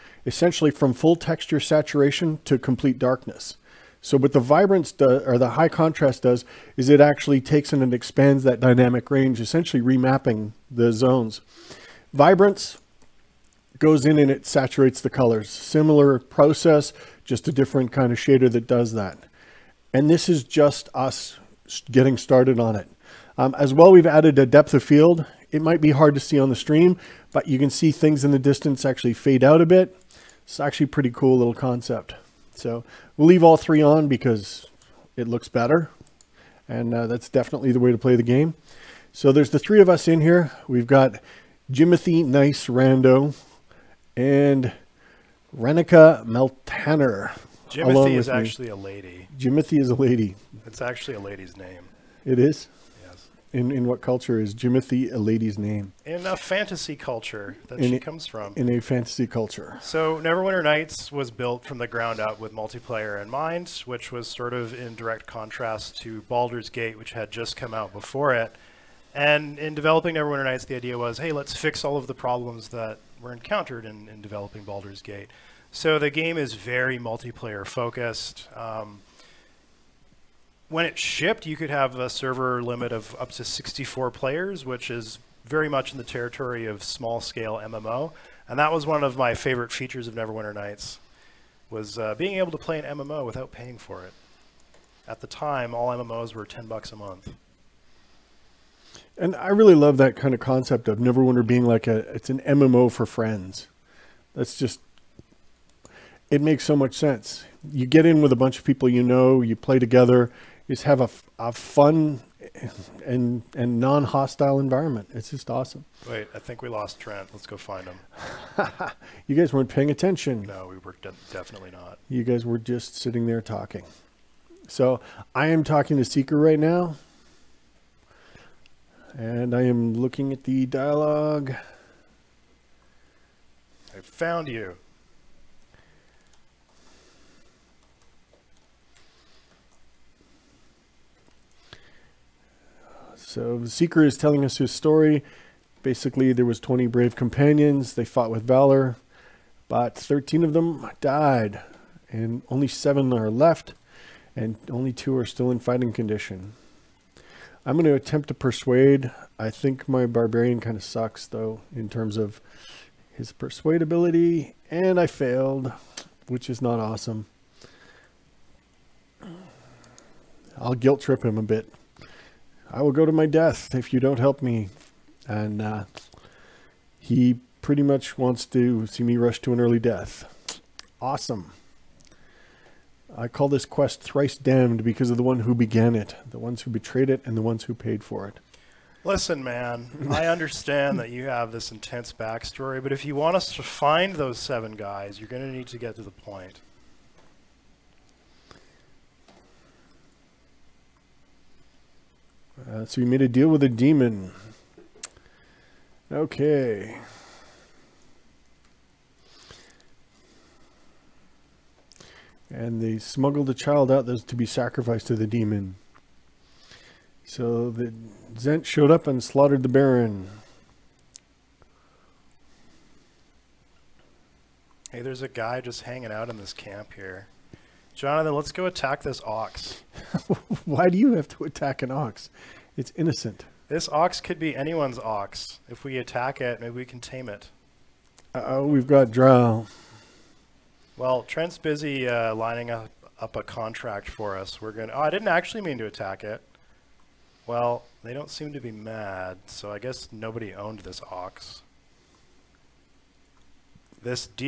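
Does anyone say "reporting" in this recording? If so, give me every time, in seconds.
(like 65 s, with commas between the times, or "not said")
not said.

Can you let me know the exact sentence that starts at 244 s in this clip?
We're going to, oh, I didn't actually mean to attack it.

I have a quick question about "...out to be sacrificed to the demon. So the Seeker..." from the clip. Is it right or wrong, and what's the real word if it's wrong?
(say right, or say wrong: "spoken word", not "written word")
wrong: "Zhent", not "Seeker".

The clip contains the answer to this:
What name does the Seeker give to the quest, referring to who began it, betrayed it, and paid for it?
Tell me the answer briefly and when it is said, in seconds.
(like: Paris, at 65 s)
Thrice damned, at 184 s.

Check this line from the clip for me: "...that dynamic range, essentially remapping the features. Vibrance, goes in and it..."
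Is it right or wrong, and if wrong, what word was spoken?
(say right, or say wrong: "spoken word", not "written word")
wrong: "zones", not "features".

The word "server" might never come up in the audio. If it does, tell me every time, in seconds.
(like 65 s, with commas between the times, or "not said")
82 s.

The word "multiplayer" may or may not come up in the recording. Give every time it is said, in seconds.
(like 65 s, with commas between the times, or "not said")
62 s, 76 s.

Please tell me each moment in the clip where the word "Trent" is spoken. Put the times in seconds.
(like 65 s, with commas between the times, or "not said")
116 s, 241 s.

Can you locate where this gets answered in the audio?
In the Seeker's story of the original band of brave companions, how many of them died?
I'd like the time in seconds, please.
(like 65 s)
149 s.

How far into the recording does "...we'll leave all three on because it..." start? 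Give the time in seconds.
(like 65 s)
33 s.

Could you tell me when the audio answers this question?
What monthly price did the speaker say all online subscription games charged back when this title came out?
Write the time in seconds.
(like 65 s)
96 s.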